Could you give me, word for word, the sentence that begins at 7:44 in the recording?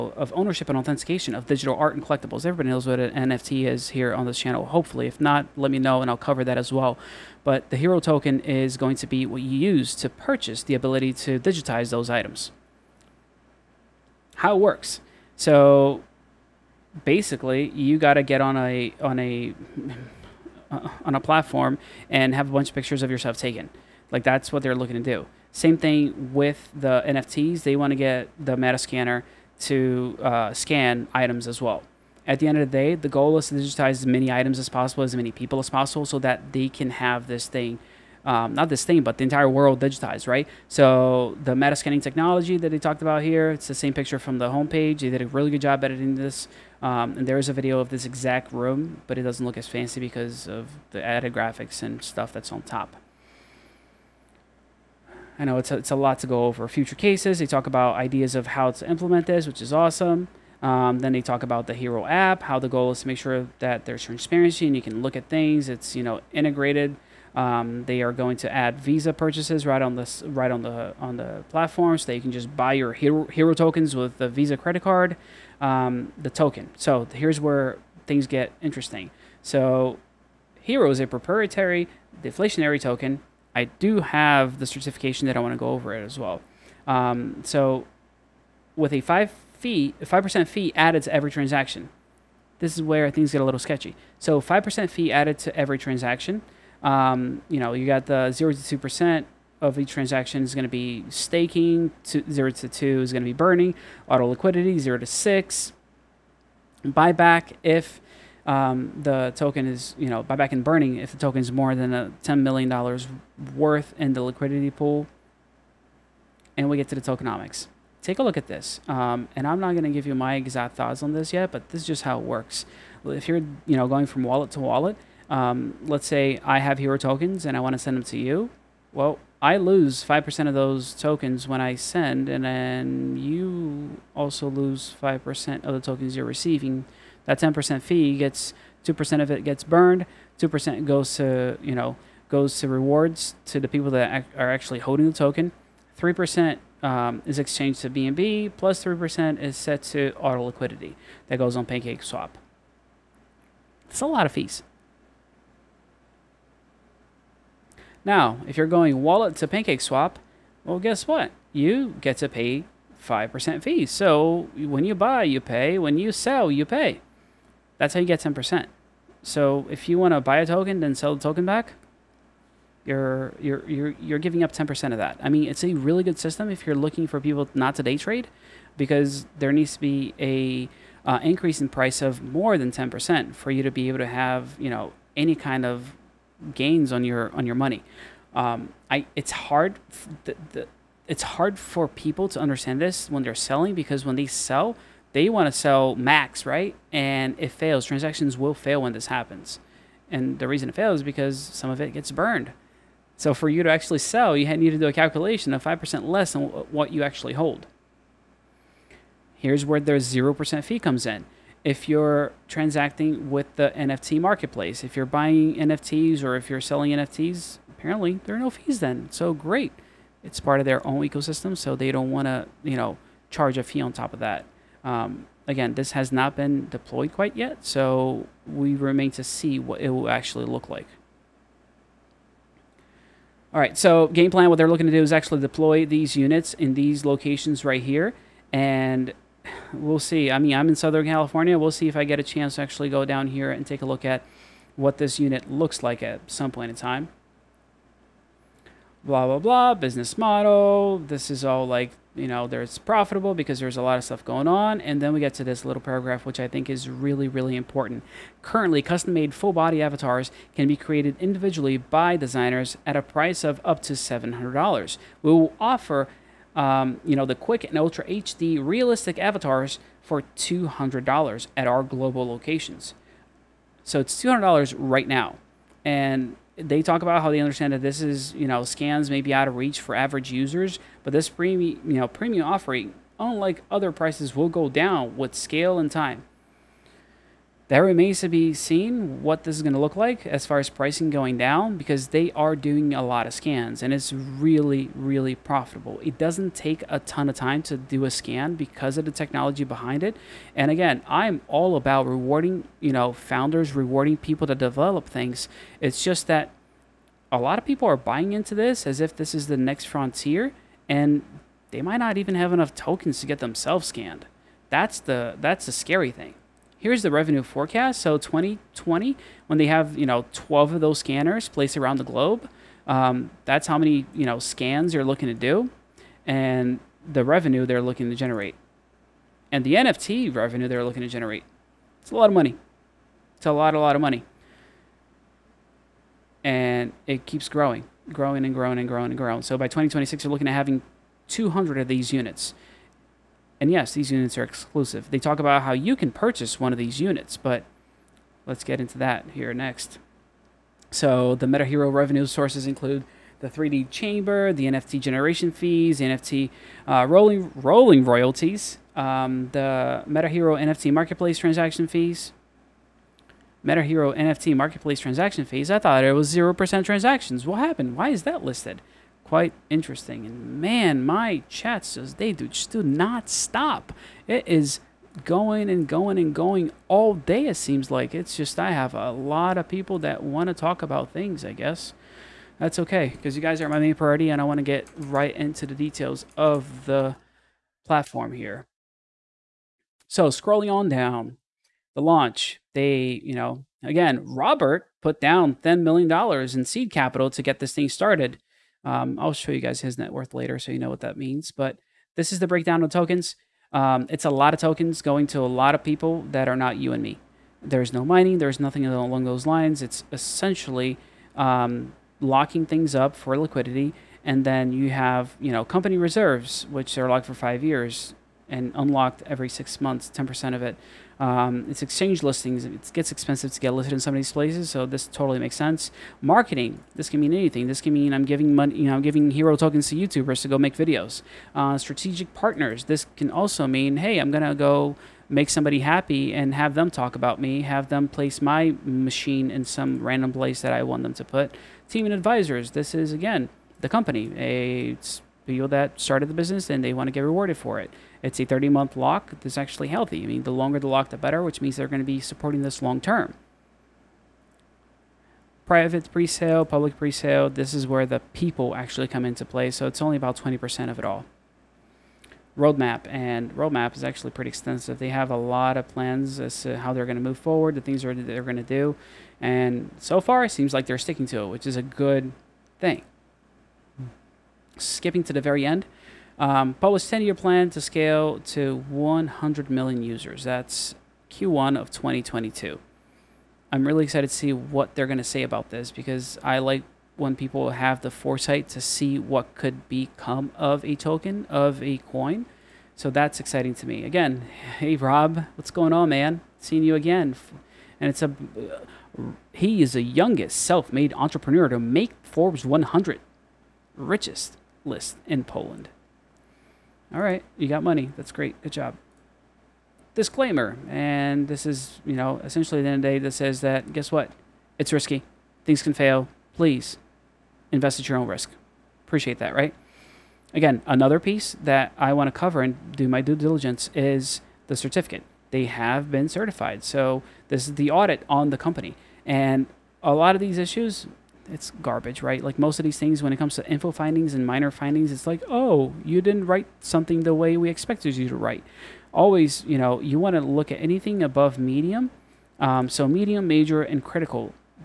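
They have a lot of plans as to how they're going to move forward, the things that they're going to do.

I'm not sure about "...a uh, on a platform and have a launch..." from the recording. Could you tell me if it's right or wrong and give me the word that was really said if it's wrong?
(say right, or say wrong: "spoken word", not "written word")
wrong: "bunch", not "launch".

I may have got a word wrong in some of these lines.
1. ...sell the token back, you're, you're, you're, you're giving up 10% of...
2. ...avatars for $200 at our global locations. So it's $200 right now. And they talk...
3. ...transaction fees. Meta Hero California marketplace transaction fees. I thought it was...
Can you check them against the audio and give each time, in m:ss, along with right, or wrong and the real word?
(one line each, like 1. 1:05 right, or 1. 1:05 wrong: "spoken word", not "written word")
1. 2:50 right
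2. 4:29 right
3. 6:01 wrong: "NFT", not "California".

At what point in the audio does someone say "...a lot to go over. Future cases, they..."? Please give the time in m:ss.
0:55.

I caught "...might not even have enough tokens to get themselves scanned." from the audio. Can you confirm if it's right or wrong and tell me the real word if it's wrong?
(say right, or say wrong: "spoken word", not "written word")
right.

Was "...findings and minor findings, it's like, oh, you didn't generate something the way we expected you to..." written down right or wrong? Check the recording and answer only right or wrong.
wrong.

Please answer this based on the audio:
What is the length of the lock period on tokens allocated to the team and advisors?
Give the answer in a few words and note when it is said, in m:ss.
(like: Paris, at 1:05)
30 months, at 7:28.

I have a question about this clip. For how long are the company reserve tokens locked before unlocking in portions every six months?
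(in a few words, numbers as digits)
5 years.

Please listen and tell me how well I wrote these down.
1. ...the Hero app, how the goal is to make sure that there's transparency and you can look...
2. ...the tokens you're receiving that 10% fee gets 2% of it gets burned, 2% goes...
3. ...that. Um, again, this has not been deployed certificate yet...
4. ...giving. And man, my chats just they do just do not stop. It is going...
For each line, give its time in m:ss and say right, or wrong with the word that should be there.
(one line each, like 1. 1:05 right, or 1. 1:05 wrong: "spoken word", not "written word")
1. 1:01 right
2. 2:15 right
3. 3:44 wrong: "quite", not "certificate"
4. 6:09 wrong: "interesting", not "giving".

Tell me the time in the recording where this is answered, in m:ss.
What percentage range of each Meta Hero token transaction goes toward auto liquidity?
1:44.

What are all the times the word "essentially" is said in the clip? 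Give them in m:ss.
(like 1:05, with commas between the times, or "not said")
6:50, 8:32.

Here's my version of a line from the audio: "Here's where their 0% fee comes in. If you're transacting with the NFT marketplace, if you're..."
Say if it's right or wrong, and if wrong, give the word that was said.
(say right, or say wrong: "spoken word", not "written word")
right.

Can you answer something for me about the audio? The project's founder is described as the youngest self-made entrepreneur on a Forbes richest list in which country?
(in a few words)
Poland.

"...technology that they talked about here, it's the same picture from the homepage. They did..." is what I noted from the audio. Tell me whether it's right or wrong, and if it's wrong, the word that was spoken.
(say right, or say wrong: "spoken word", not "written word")
right.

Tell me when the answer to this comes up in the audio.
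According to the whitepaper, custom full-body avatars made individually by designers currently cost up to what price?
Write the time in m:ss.
4:23.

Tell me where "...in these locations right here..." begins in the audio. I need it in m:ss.
3:56.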